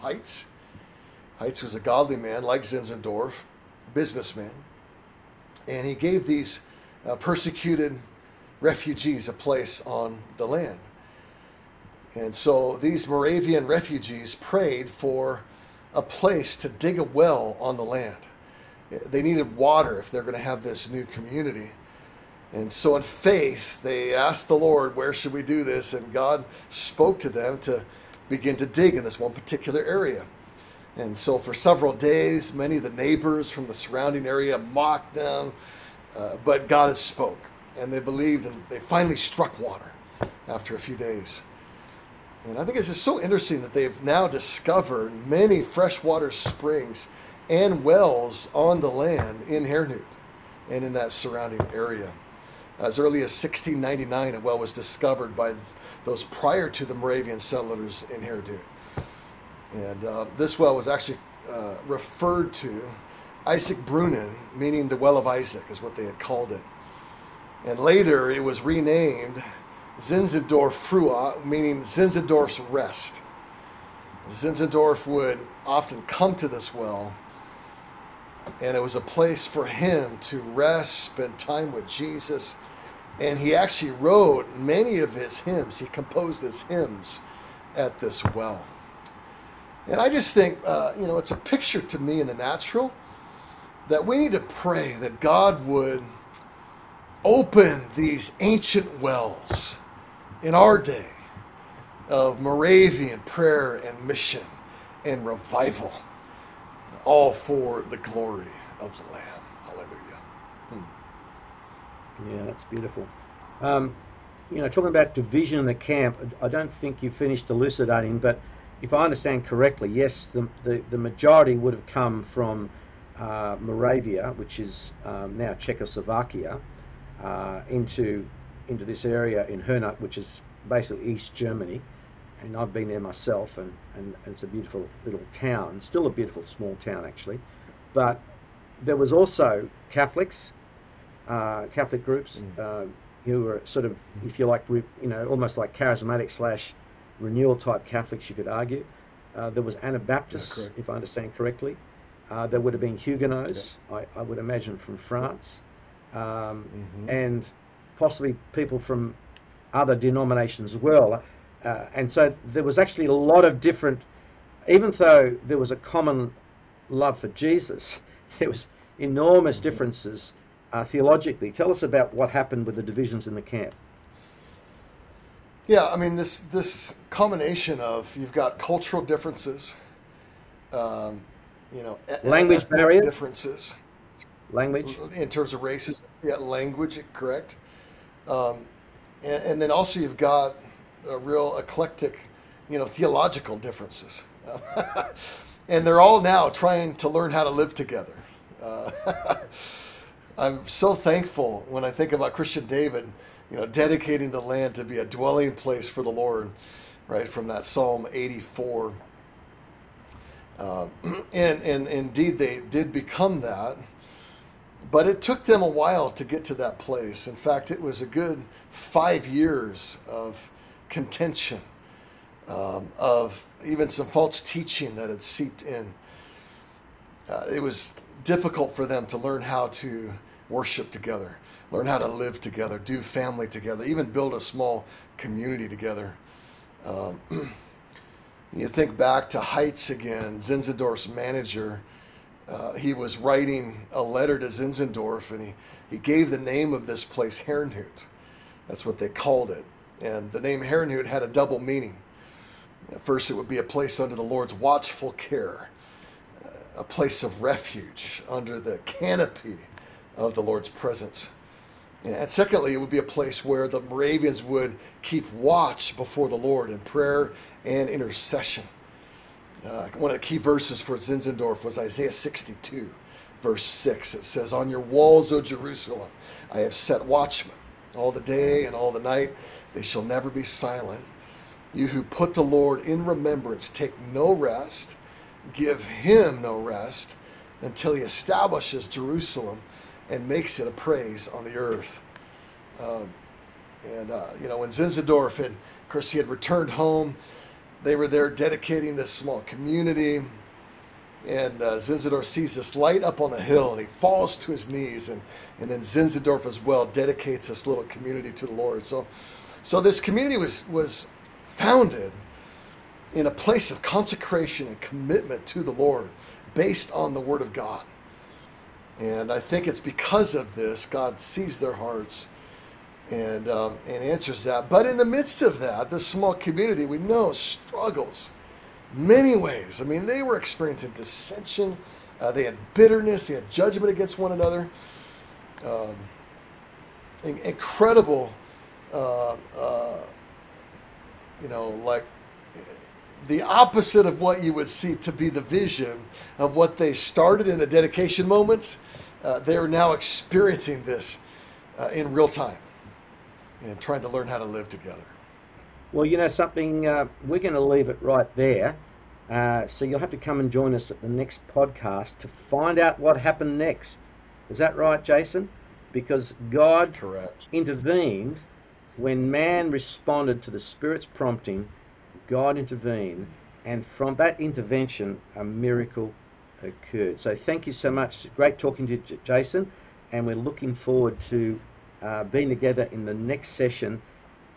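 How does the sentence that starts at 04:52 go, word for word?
Um, and, uh, you know, when Zinzendorf, and of course, he had returned home they were there dedicating this small community.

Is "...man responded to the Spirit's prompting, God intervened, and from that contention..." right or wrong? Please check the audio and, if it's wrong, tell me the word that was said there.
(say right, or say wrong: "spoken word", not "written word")
wrong: "intervention", not "contention".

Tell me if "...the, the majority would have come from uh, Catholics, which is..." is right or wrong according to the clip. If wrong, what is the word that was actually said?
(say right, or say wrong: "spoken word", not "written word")
wrong: "Moravia", not "Catholics".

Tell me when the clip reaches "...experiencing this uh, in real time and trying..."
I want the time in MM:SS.
05:49.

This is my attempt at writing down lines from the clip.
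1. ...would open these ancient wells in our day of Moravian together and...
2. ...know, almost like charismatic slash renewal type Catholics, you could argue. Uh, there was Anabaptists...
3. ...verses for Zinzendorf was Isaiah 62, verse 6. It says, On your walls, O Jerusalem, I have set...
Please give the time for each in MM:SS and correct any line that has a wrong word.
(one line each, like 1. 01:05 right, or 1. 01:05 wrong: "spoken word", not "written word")
1. 01:35 wrong: "prayer", not "together"
2. 02:25 right
3. 04:30 right.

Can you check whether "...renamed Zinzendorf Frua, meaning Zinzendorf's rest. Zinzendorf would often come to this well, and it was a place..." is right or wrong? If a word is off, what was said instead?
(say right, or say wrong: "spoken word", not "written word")
right.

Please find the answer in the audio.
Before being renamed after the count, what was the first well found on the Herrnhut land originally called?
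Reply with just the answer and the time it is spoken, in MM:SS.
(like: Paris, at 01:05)
Isaac Brunnen, at 01:03.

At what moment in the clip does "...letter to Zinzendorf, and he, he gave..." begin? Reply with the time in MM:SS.
04:04.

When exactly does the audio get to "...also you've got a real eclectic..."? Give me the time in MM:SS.
03:09.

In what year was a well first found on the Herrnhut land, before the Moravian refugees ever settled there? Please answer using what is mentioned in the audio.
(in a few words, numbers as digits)
1699.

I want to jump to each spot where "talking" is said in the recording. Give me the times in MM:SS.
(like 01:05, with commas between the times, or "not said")
01:54, 06:18.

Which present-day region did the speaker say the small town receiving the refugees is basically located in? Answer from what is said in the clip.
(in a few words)
East Germany.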